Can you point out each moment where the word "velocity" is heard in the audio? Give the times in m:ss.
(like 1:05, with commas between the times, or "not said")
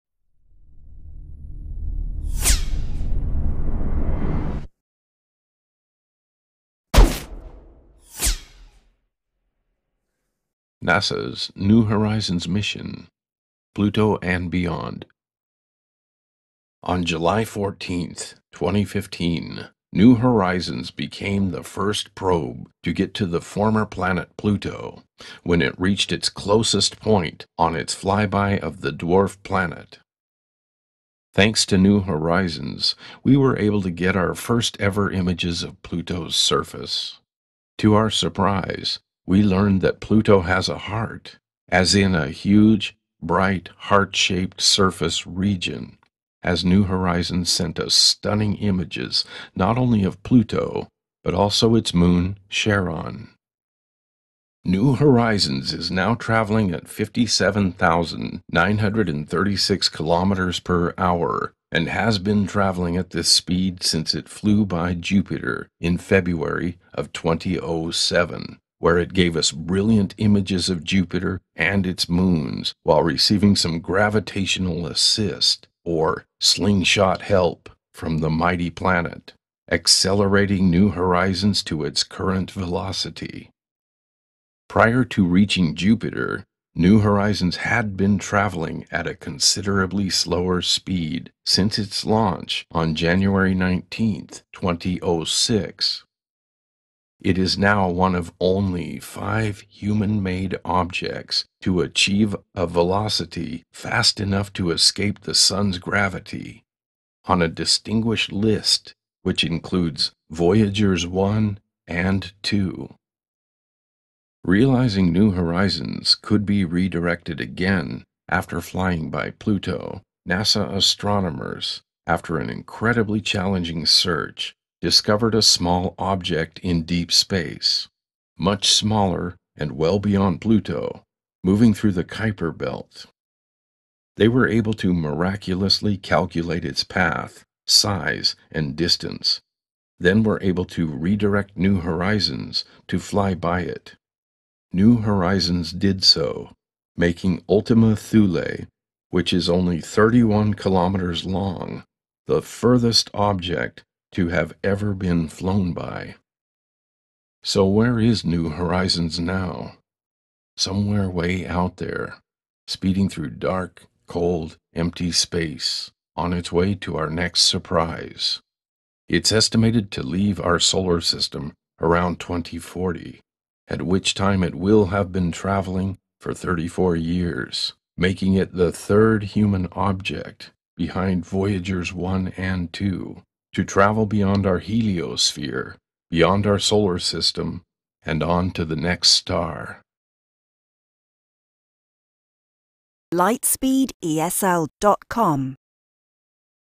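1:22, 1:42.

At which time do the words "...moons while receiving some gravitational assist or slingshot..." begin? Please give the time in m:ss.
1:12.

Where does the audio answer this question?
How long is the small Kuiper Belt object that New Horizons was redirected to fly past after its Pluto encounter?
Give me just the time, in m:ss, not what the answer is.
2:29.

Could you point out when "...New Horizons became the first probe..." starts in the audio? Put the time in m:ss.
0:19.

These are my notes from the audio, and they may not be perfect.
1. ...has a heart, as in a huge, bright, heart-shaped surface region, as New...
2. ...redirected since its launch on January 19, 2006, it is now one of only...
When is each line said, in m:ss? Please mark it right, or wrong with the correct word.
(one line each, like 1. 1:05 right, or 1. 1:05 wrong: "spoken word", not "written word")
1. 0:40 right
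2. 1:30 wrong: "speed", not "redirected".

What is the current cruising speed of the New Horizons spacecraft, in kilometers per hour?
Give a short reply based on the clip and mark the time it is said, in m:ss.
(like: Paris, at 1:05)
57,936 kilometers per hour, at 0:56.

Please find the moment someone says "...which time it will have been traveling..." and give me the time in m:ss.
2:53.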